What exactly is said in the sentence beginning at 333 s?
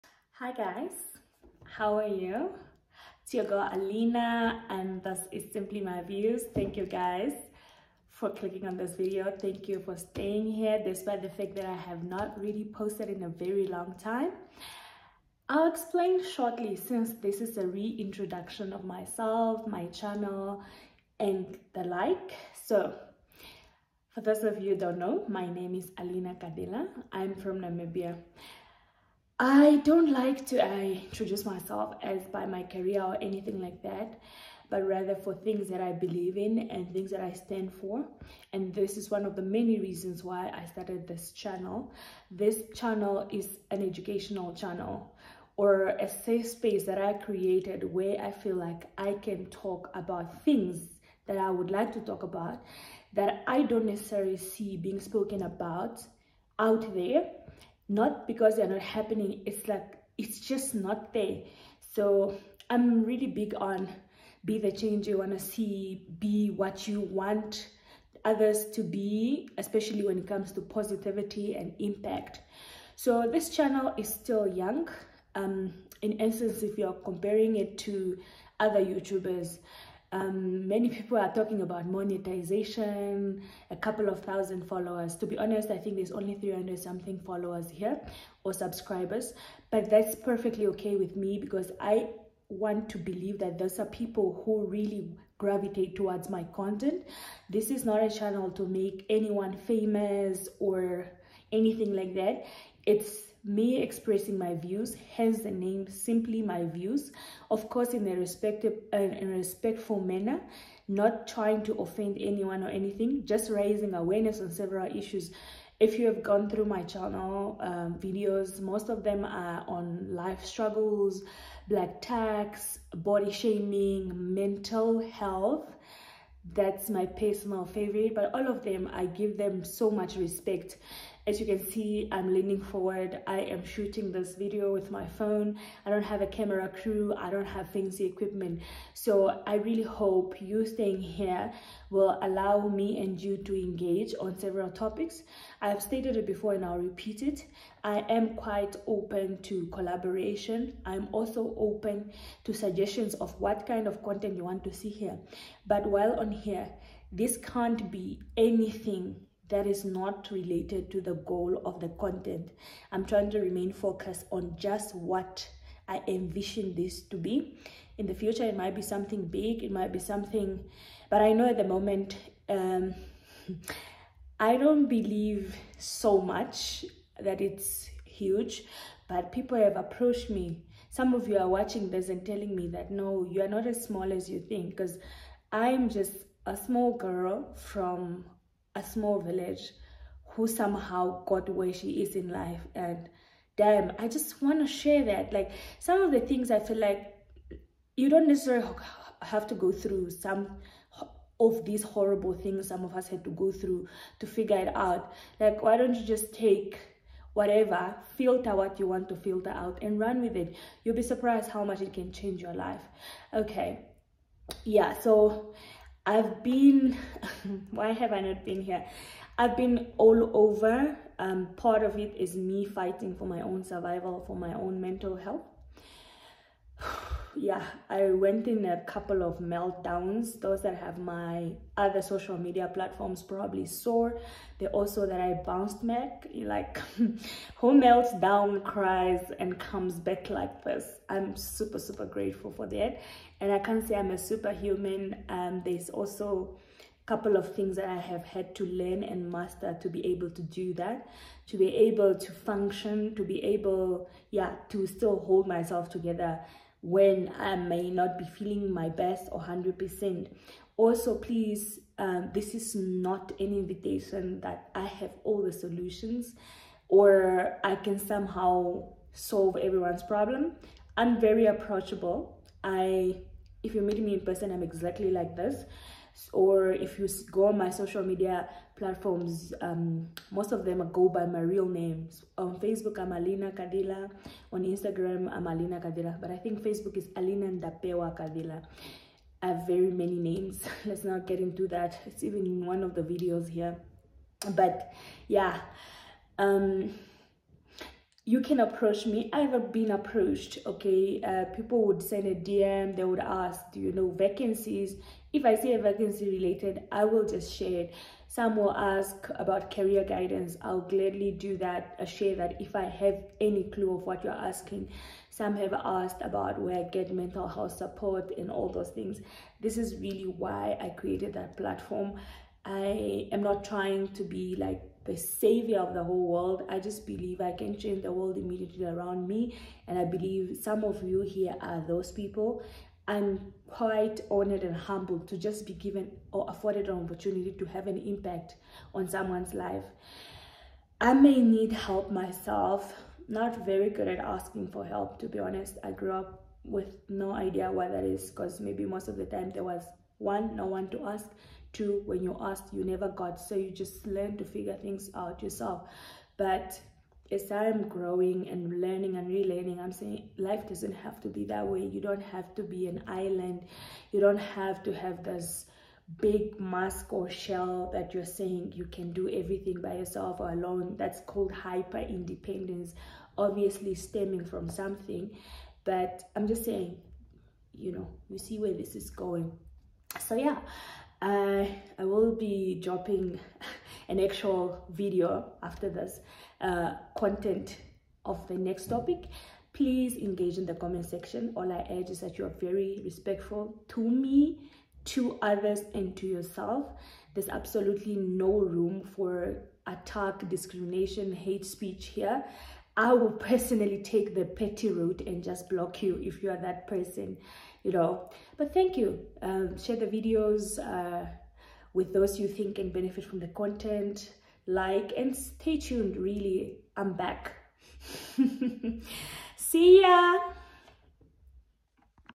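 I'm quite honored and humbled to just be given or afforded an opportunity to have an impact on someone's life.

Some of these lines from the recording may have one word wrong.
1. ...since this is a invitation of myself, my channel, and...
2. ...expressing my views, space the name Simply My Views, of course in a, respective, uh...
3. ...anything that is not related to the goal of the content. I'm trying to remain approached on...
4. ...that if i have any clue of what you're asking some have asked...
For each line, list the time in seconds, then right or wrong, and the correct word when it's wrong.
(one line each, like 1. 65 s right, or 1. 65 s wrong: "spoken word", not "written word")
1. 16 s wrong: "reintroduction", not "invitation"
2. 103 s wrong: "hence", not "space"
3. 158 s wrong: "focused", not "approached"
4. 312 s right.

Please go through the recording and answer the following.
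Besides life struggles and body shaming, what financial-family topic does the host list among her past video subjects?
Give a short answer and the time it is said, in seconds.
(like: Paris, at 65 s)
Black tax, at 121 s.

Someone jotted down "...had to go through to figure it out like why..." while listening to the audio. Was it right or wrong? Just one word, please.
right.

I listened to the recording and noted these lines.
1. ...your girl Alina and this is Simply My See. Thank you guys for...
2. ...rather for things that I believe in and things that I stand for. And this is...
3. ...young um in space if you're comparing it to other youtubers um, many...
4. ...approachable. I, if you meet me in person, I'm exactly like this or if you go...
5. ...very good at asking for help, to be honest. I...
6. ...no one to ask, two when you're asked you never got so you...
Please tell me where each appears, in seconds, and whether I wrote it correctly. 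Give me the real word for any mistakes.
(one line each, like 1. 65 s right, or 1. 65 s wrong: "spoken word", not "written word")
1. 3 s wrong: "Views", not "See"
2. 34 s right
3. 74 s wrong: "essence", not "space"
4. 271 s right
5. 343 s right
6. 350 s right.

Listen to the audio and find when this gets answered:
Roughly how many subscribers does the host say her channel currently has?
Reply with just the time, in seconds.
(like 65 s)
86 s.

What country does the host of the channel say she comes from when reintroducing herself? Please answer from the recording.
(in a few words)
Namibia.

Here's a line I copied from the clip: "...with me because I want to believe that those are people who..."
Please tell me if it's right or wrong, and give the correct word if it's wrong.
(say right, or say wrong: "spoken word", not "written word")
right.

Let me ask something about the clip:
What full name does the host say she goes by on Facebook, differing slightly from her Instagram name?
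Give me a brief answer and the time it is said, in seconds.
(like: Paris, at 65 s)
Alina Ndapewa Kadhila, at 287 s.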